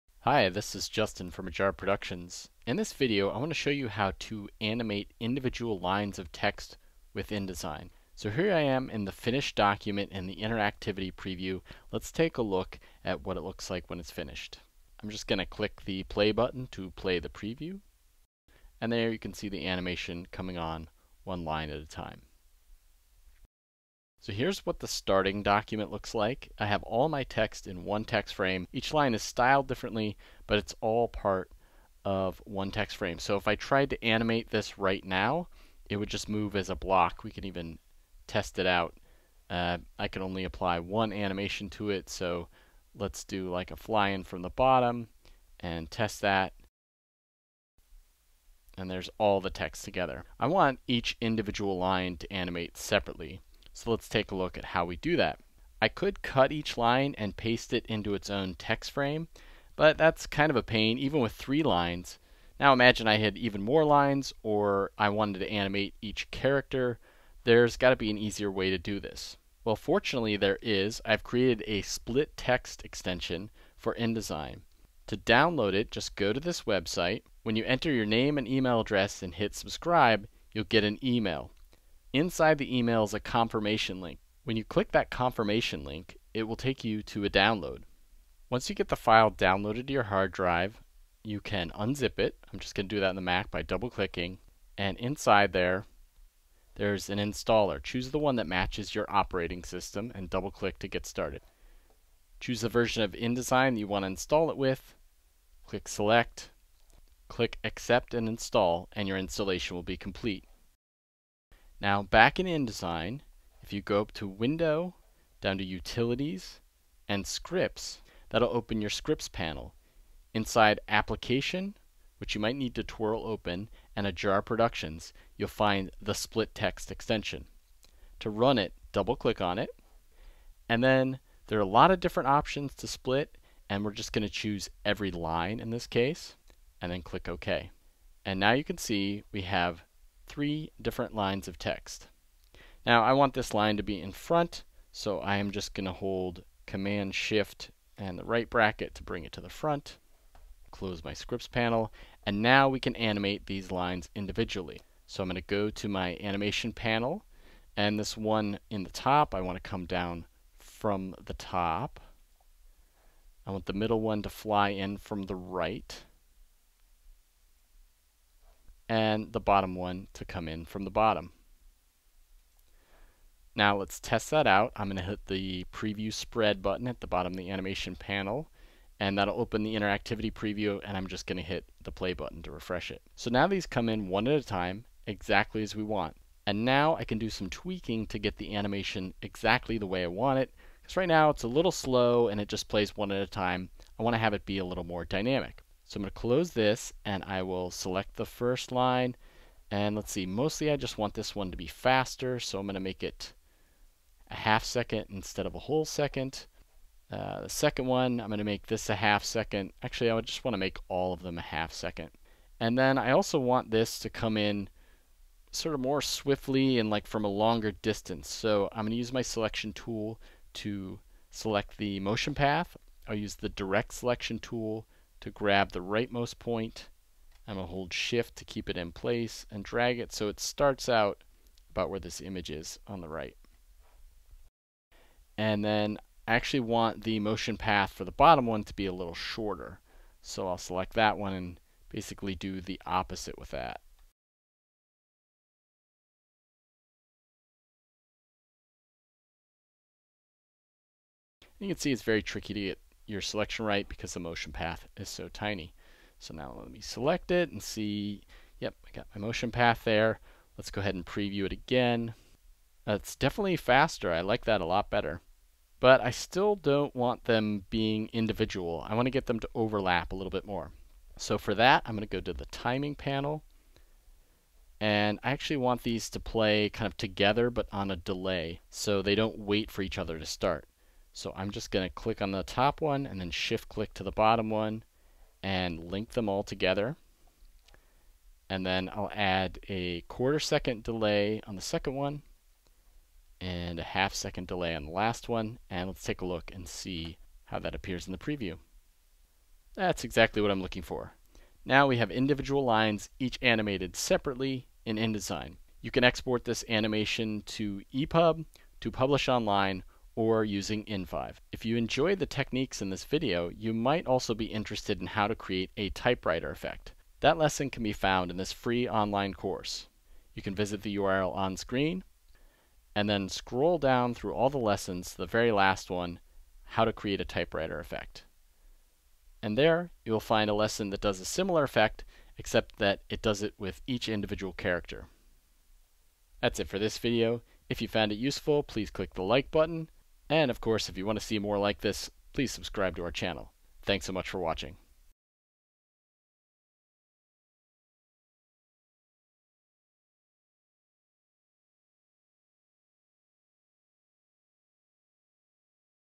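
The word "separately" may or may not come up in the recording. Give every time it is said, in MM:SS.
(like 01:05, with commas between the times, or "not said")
00:52, 05:03.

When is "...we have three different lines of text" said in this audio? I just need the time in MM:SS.
02:19.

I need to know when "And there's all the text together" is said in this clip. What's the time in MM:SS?
00:48.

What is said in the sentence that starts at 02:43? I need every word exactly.
I want the middle one to fly in from the right and the bottom one to come in from the bottom.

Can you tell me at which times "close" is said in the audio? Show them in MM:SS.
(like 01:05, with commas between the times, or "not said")
02:30, 03:16.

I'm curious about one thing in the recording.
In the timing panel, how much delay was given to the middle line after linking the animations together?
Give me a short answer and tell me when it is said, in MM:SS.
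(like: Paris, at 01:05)
Quarter second, at 04:49.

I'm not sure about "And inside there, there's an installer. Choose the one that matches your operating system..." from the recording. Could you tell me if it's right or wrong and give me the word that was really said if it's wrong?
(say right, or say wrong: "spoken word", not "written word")
right.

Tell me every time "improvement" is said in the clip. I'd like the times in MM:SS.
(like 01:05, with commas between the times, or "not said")
not said.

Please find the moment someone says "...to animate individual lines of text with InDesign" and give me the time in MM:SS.
00:04.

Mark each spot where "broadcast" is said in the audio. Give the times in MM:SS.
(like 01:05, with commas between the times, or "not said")
not said.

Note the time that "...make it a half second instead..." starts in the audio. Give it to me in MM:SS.
03:22.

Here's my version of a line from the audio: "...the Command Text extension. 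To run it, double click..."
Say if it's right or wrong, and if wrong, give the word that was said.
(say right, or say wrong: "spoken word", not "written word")
wrong: "Split", not "Command".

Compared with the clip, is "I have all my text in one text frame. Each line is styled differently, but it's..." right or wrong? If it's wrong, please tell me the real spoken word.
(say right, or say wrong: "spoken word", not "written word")
right.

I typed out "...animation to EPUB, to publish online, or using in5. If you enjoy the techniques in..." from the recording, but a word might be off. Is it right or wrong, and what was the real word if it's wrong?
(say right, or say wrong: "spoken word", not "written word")
right.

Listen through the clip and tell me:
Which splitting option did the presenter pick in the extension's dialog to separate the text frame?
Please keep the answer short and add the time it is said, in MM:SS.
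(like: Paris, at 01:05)
Every line, at 02:14.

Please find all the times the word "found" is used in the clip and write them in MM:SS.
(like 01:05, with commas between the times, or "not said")
05:17, 05:37.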